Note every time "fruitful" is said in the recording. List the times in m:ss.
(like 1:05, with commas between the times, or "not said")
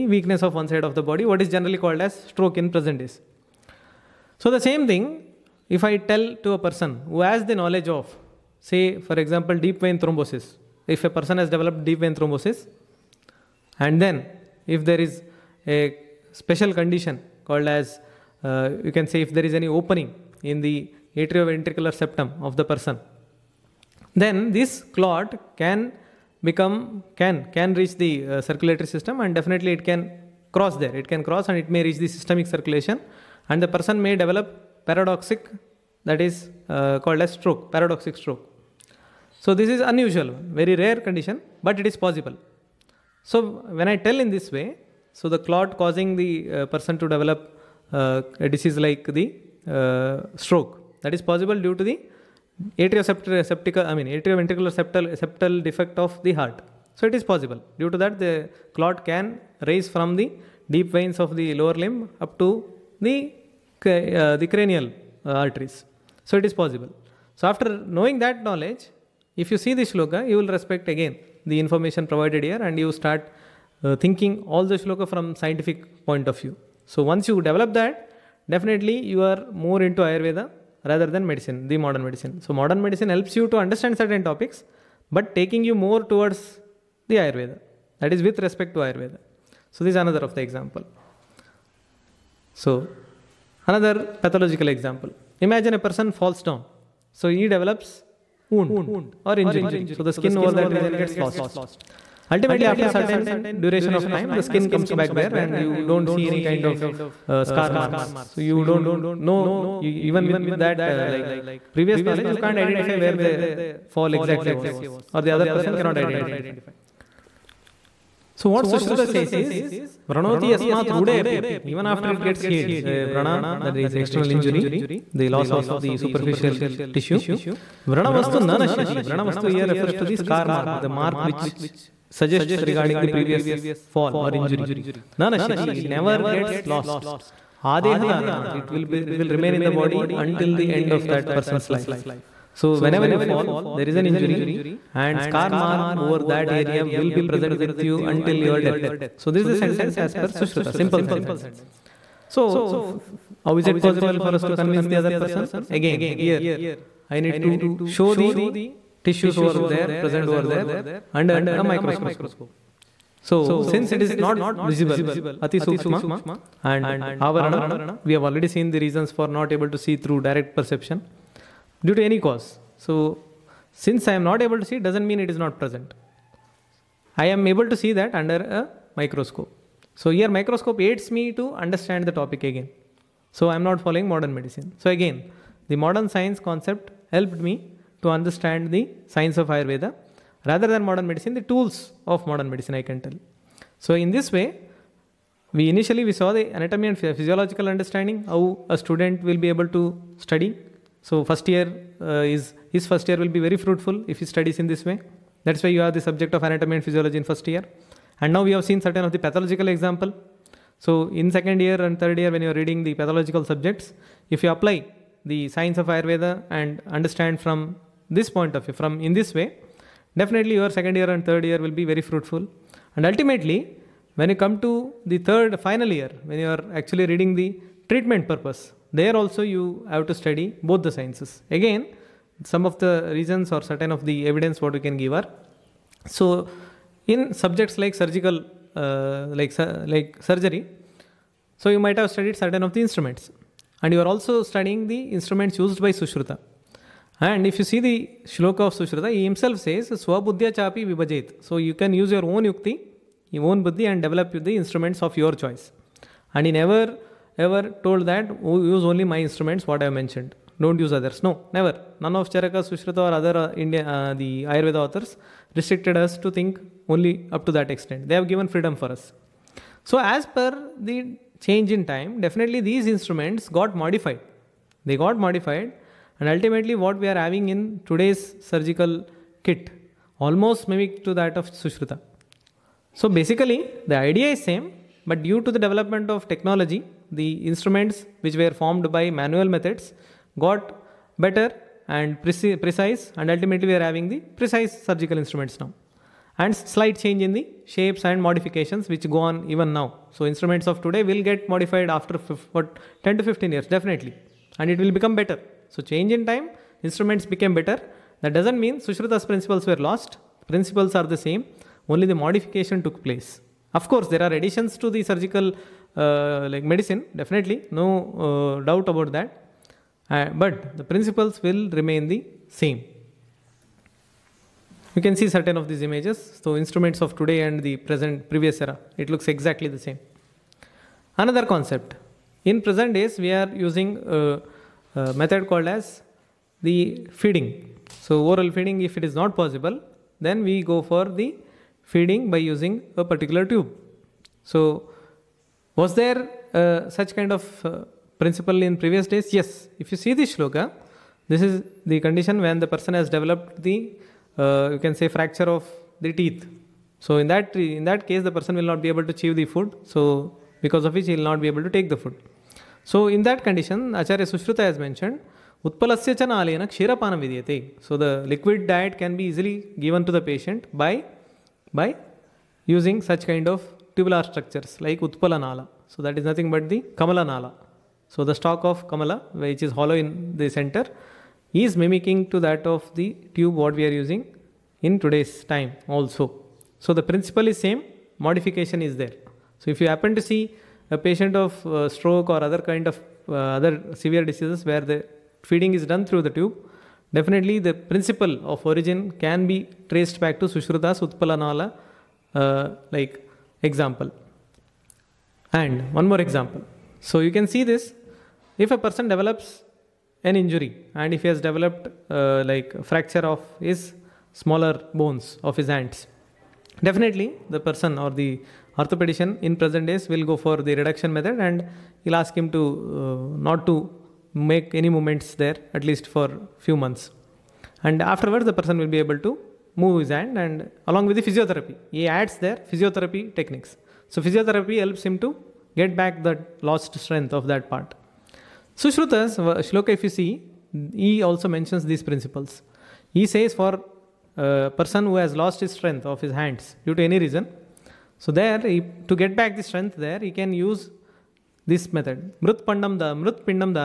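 3:23, 3:42.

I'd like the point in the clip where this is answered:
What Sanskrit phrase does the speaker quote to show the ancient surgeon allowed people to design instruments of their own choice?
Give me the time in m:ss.
4:10.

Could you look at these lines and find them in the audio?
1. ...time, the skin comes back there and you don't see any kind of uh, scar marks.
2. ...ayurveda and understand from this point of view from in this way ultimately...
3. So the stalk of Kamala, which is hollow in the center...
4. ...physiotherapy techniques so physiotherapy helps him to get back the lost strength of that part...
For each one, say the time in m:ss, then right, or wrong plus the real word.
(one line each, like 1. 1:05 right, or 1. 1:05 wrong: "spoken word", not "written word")
1. 1:44 right
2. 3:35 wrong: "definitely", not "ultimately"
3. 6:18 right
4. 7:12 right.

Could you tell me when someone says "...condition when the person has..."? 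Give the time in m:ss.
5:52.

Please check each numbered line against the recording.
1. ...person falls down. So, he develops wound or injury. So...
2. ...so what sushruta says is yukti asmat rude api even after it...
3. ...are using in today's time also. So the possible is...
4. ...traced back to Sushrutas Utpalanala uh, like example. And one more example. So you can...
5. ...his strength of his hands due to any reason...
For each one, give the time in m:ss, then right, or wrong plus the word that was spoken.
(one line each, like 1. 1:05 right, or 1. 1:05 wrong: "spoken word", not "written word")
1. 1:35 right
2. 1:58 wrong: "vranoti", not "yukti"
3. 6:23 wrong: "principle", not "possible"
4. 6:39 right
5. 7:25 right.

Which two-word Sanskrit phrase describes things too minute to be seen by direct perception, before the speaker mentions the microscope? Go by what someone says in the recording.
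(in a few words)
Ati Sukshma.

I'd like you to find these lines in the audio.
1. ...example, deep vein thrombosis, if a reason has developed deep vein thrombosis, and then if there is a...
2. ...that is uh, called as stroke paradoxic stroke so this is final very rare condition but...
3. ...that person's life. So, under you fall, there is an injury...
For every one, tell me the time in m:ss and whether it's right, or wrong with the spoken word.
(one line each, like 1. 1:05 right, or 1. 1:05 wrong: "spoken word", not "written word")
1. 0:09 wrong: "person", not "reason"
2. 0:36 wrong: "unusual", not "final"
3. 2:21 wrong: "whenever", not "under".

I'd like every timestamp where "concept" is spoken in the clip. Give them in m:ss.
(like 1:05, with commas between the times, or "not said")
3:06, 5:31.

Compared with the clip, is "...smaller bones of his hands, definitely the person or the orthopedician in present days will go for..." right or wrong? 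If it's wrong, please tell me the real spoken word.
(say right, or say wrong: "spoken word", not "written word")
right.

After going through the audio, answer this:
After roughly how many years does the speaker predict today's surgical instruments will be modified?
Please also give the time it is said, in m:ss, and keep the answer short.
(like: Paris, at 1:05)
10 to 15 years, at 5:03.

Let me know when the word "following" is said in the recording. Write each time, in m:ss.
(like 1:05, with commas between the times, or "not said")
3:03.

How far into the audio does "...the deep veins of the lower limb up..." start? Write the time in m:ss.
1:00.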